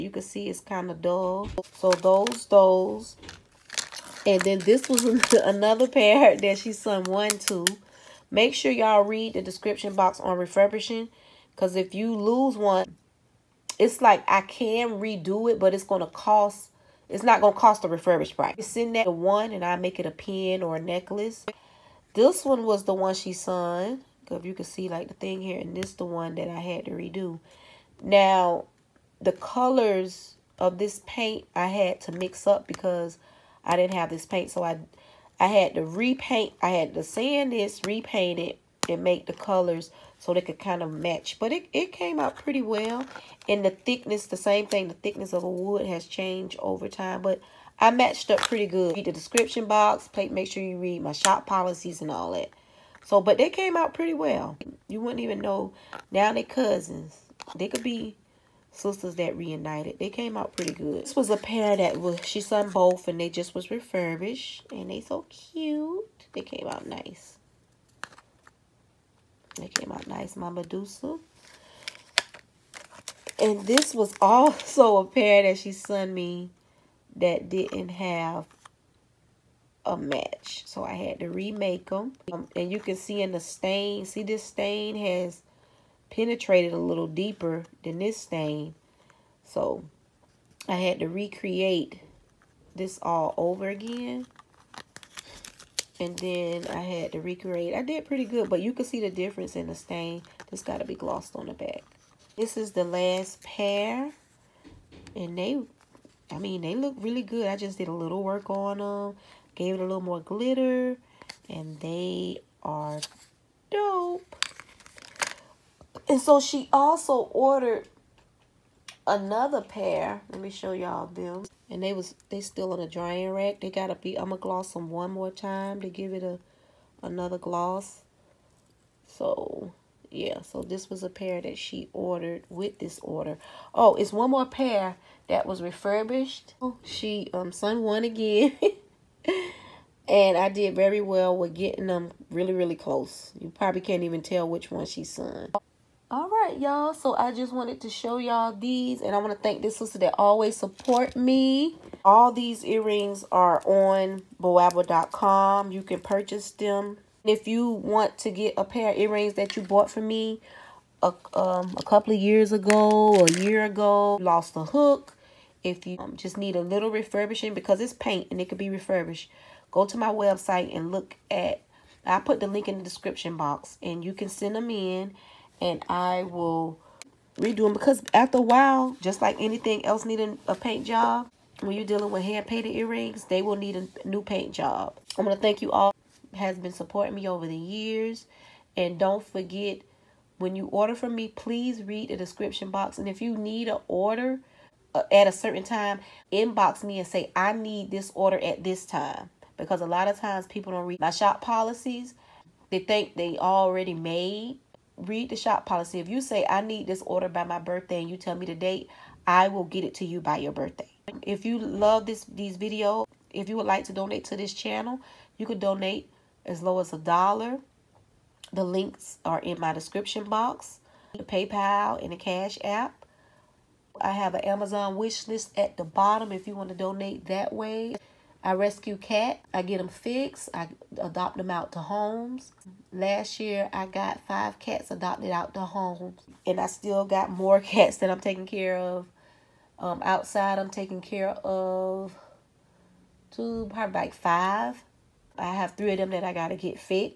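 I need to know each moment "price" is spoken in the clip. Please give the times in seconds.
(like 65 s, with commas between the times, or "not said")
18 s.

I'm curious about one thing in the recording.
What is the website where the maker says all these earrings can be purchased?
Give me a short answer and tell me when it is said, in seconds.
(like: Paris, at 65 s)
boabw.com, at 154 s.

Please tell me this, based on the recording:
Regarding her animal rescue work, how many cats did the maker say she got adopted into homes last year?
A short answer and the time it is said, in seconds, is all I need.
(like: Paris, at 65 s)
5, at 234 s.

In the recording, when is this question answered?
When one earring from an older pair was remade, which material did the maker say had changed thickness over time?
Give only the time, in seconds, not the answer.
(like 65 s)
44 s.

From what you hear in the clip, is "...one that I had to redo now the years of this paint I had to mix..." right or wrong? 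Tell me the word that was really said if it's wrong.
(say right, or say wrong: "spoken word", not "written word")
wrong: "colors", not "years".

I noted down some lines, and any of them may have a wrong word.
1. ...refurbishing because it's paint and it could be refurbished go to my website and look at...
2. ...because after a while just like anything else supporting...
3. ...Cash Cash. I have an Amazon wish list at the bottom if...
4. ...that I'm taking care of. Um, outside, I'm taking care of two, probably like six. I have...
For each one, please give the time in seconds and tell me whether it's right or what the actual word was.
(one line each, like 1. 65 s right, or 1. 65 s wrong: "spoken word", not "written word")
1. 166 s right
2. 177 s wrong: "needing", not "supporting"
3. 222 s wrong: "App", not "Cash"
4. 237 s wrong: "five", not "six".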